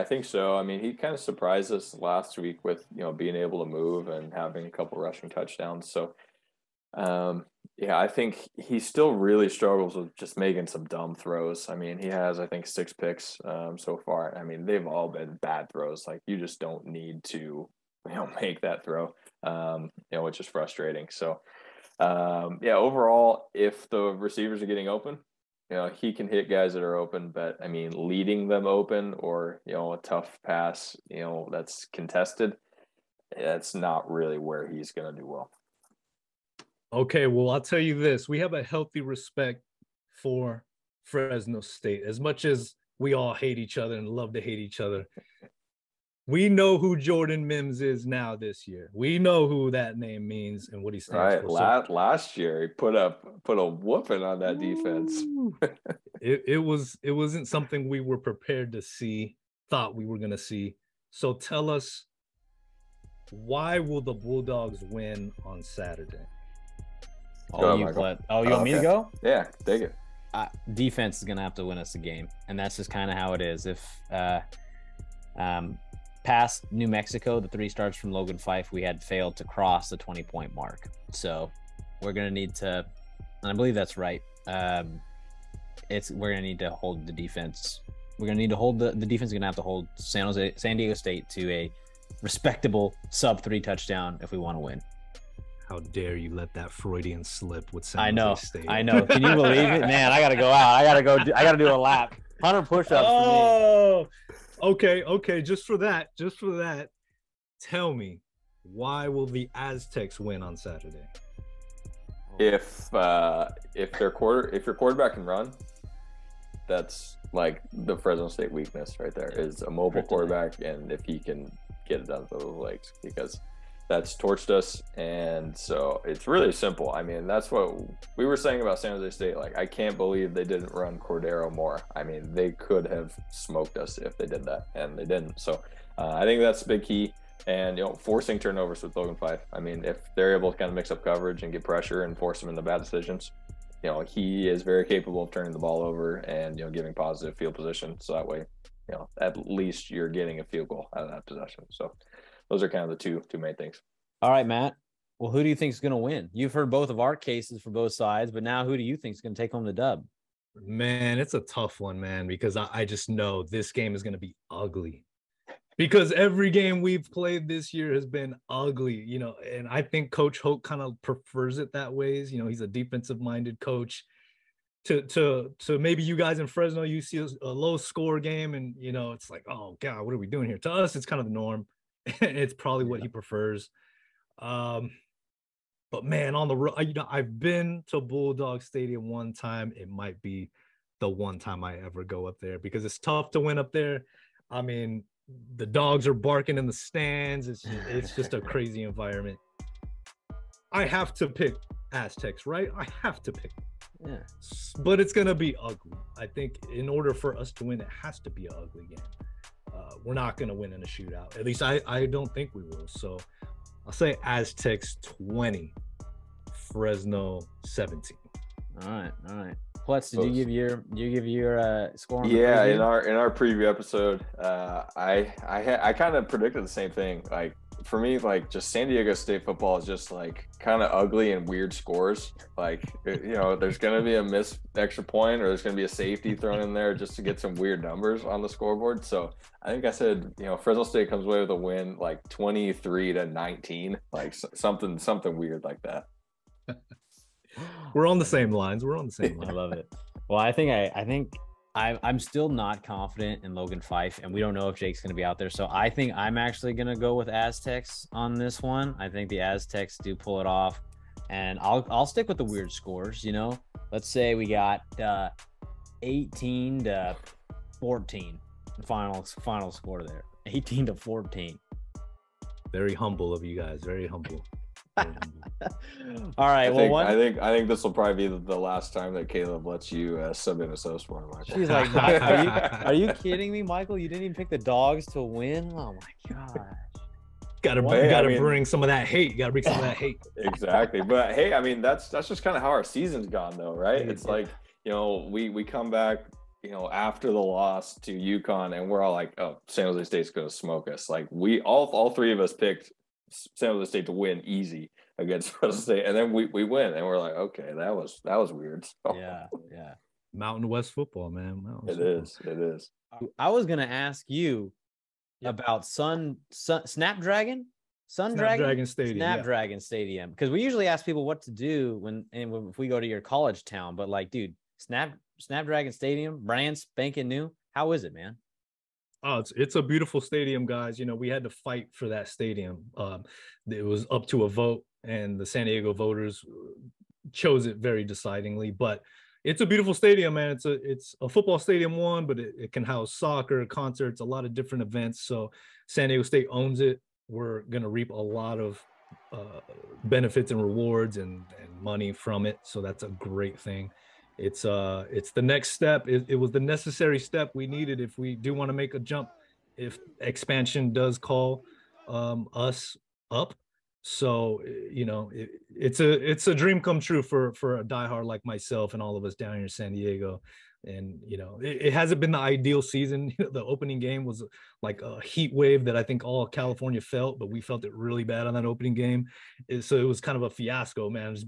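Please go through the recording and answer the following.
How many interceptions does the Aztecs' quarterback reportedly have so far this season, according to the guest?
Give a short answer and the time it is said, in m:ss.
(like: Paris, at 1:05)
6, at 0:12.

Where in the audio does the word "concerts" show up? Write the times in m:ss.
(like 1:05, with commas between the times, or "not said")
5:43.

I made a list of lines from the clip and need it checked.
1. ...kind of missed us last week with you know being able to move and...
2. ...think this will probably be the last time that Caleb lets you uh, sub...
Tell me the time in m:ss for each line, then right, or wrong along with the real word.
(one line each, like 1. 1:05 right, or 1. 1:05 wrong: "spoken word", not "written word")
1. 0:00 wrong: "surprised", not "missed"
2. 4:37 right.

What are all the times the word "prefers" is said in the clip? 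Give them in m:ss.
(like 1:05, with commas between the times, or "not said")
2:51, 3:03.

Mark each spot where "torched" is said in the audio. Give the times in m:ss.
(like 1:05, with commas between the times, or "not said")
2:04.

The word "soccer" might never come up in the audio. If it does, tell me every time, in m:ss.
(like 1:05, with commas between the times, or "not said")
5:43.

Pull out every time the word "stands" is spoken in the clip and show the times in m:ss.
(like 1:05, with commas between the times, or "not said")
0:50, 3:16.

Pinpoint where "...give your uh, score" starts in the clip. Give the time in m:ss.
3:41.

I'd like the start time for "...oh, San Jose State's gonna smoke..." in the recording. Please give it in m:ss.
4:59.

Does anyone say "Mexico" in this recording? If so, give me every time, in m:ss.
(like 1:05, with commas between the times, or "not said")
1:16.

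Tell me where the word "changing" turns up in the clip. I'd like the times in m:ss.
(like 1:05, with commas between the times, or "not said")
not said.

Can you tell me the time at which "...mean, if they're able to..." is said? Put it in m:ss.
2:19.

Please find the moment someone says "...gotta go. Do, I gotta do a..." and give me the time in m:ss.
1:40.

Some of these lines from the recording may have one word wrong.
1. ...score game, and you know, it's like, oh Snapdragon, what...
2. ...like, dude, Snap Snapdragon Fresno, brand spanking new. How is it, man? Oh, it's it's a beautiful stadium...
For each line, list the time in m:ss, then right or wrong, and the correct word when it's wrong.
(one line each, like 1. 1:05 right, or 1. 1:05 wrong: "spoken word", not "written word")
1. 2:57 wrong: "God", not "Snapdragon"
2. 5:24 wrong: "Stadium", not "Fresno".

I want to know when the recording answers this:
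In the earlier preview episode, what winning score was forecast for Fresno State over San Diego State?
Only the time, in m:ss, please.
4:02.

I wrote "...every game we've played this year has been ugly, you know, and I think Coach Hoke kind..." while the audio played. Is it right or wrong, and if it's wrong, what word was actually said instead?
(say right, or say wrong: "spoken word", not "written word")
right.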